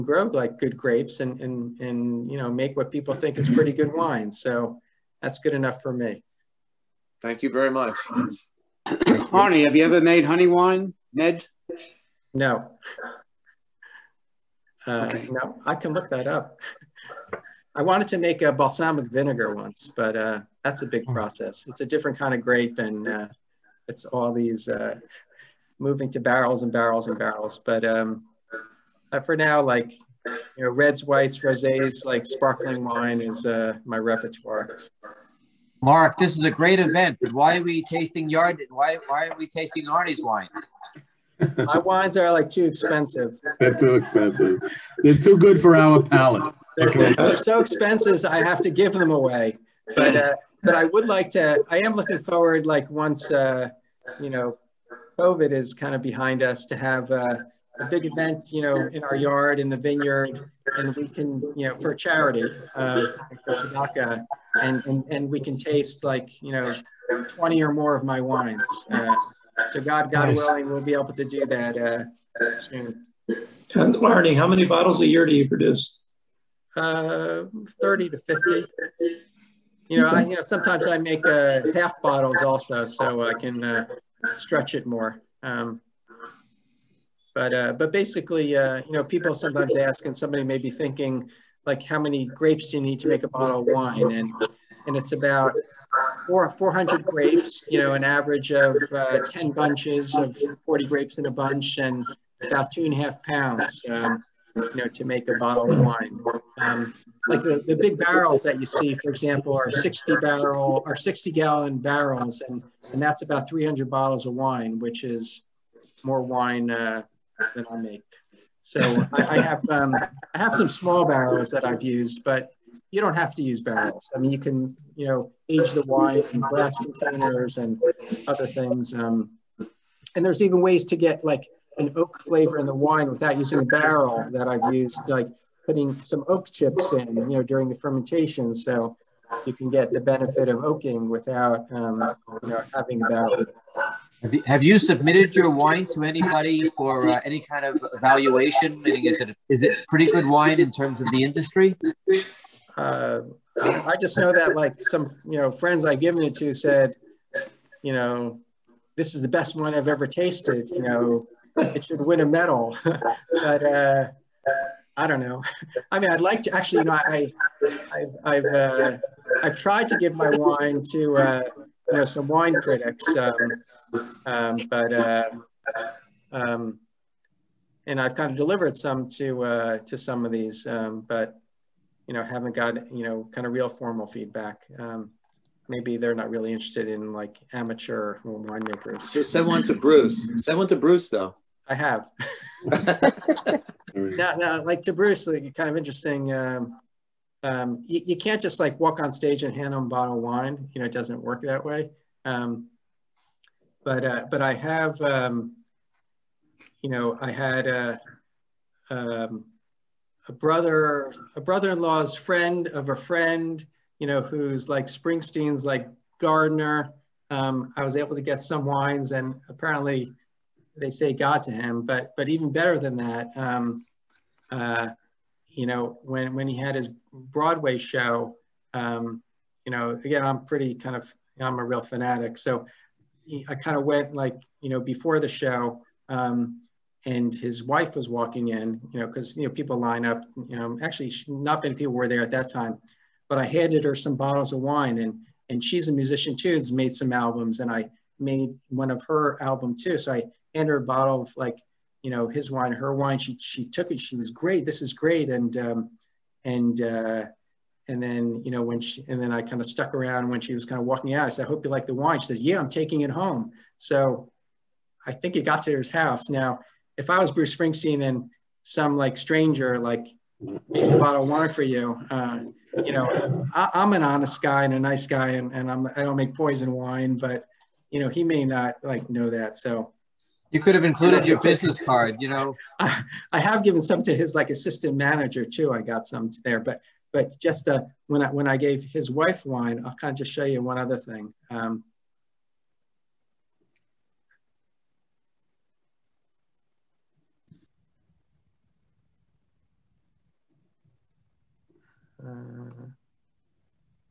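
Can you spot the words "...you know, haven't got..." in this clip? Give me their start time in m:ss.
3:02.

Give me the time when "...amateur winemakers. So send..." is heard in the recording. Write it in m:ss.
3:07.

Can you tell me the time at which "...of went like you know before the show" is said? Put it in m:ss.
3:53.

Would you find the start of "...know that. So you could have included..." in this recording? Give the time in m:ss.
4:39.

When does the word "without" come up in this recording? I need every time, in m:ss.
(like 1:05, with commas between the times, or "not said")
2:13, 2:21.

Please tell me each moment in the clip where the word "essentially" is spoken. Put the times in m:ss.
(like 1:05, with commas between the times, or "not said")
not said.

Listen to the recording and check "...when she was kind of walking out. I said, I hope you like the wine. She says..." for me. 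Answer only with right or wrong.
right.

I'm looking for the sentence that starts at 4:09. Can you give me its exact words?
So I hand her a bottle of like, you know, his wine, her wine.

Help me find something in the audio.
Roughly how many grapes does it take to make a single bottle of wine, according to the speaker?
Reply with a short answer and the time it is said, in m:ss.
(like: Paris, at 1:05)
400, at 1:36.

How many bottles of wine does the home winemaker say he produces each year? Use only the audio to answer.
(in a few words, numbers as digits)
30 to 50.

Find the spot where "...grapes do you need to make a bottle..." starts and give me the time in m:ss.
1:32.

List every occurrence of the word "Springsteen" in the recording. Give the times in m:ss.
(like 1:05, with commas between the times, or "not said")
3:34, 4:27.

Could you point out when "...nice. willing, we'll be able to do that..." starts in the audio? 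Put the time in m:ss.
1:10.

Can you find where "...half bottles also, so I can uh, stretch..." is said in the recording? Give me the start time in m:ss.
1:21.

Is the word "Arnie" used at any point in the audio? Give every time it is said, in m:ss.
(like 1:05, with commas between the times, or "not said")
0:08, 0:39, 1:13.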